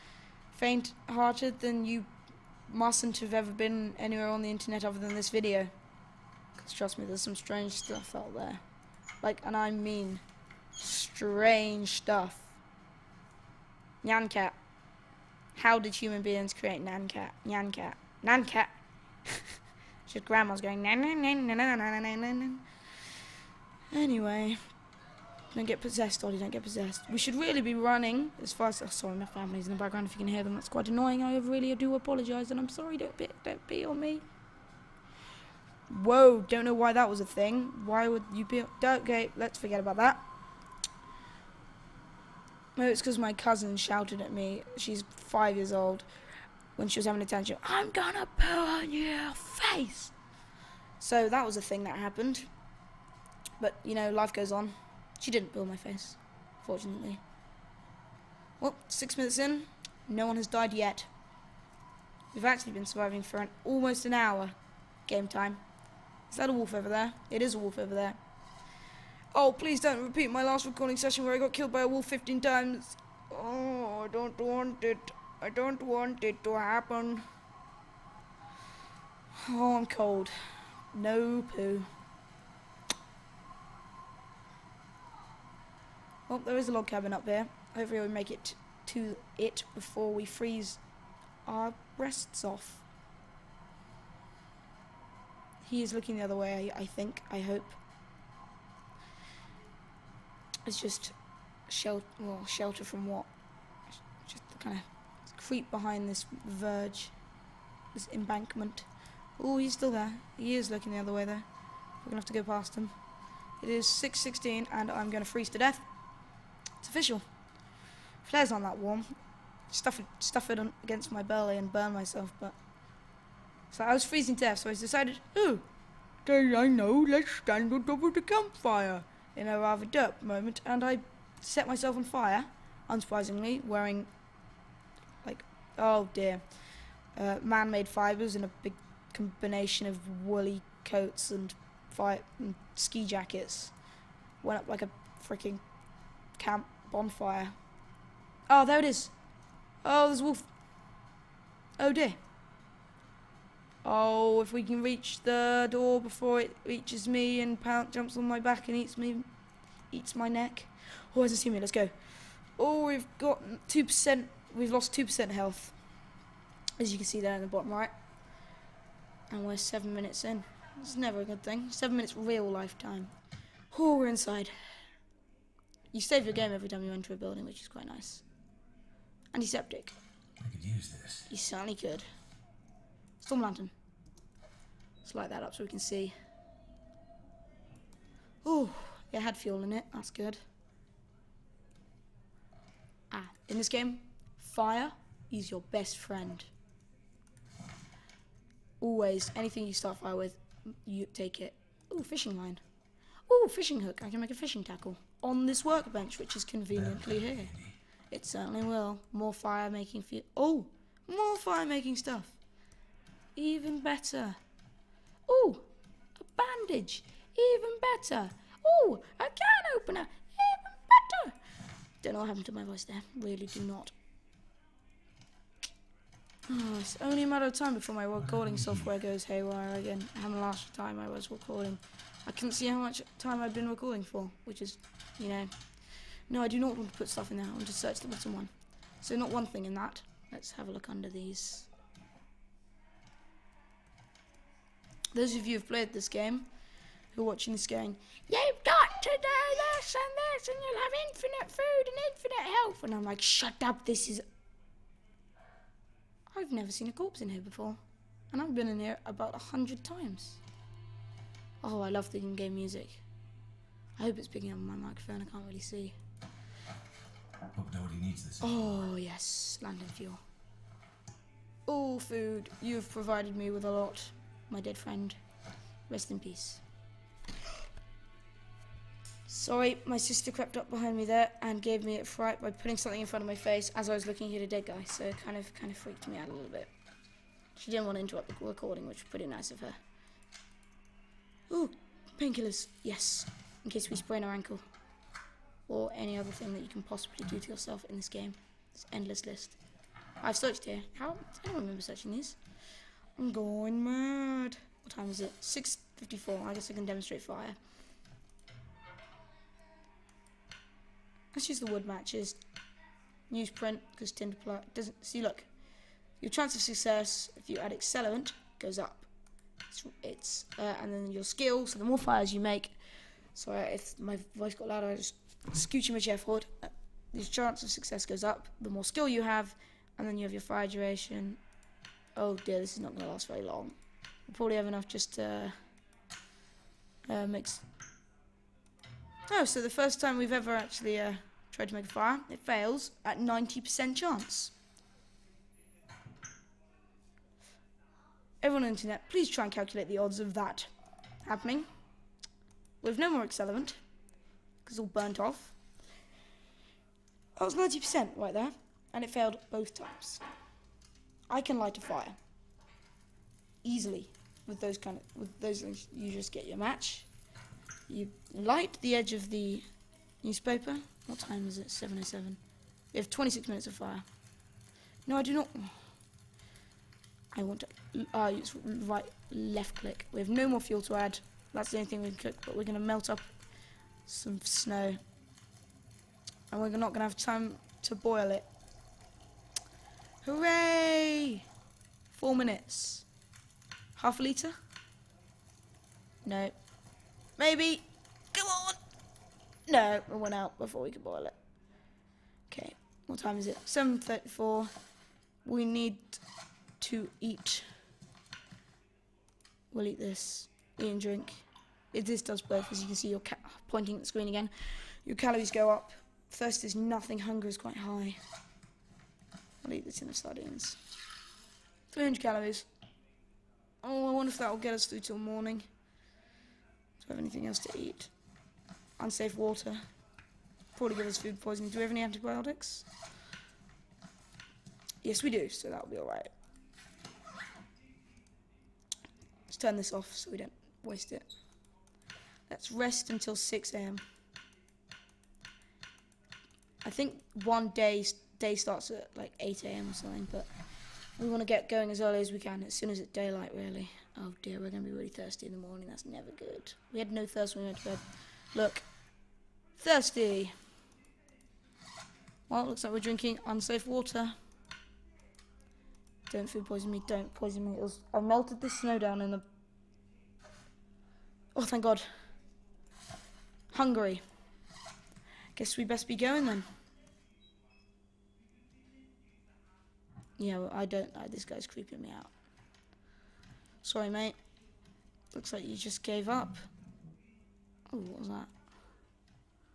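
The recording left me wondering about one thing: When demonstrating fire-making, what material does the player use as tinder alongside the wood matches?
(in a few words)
Newsprint.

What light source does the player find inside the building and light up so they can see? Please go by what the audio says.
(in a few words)
Storm lantern.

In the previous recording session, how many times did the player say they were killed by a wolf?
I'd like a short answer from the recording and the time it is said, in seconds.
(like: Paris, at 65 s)
15, at 72 s.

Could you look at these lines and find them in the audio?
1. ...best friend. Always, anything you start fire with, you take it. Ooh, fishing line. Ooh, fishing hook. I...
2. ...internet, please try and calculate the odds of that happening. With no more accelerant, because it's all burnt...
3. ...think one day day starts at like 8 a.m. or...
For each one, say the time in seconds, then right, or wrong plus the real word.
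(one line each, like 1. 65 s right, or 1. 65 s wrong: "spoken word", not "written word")
1. 195 s right
2. 348 s right
3. 446 s right.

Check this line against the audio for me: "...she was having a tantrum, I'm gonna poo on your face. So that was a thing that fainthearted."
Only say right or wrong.
wrong.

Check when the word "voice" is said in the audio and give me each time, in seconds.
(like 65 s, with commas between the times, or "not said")
222 s, 324 s.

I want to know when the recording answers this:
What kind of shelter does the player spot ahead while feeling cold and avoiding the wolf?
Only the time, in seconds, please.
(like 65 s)
86 s.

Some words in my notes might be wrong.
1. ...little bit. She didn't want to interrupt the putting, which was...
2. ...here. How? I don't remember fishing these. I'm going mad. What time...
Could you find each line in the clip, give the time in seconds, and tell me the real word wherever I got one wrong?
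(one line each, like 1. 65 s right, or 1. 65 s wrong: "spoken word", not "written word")
1. 286 s wrong: "recording", not "putting"
2. 300 s wrong: "searching", not "fishing".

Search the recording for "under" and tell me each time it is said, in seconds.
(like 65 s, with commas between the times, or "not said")
240 s.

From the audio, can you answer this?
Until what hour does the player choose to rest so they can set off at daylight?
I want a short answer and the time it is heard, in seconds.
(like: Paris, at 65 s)
6 a.m., at 443 s.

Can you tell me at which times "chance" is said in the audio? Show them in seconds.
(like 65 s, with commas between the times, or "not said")
316 s, 327 s, 343 s.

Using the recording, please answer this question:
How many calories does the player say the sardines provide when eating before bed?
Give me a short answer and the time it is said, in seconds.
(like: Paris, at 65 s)
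300, at 421 s.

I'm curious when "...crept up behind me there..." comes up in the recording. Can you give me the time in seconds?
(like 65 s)
280 s.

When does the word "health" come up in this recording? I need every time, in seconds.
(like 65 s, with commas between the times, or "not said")
165 s, 252 s.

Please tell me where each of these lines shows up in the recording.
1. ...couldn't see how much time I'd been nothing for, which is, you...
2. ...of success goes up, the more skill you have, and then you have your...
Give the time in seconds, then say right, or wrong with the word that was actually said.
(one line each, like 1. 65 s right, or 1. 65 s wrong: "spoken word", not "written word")
1. 232 s wrong: "recording", not "nothing"
2. 327 s right.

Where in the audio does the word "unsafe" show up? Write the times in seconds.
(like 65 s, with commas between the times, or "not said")
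429 s, 463 s.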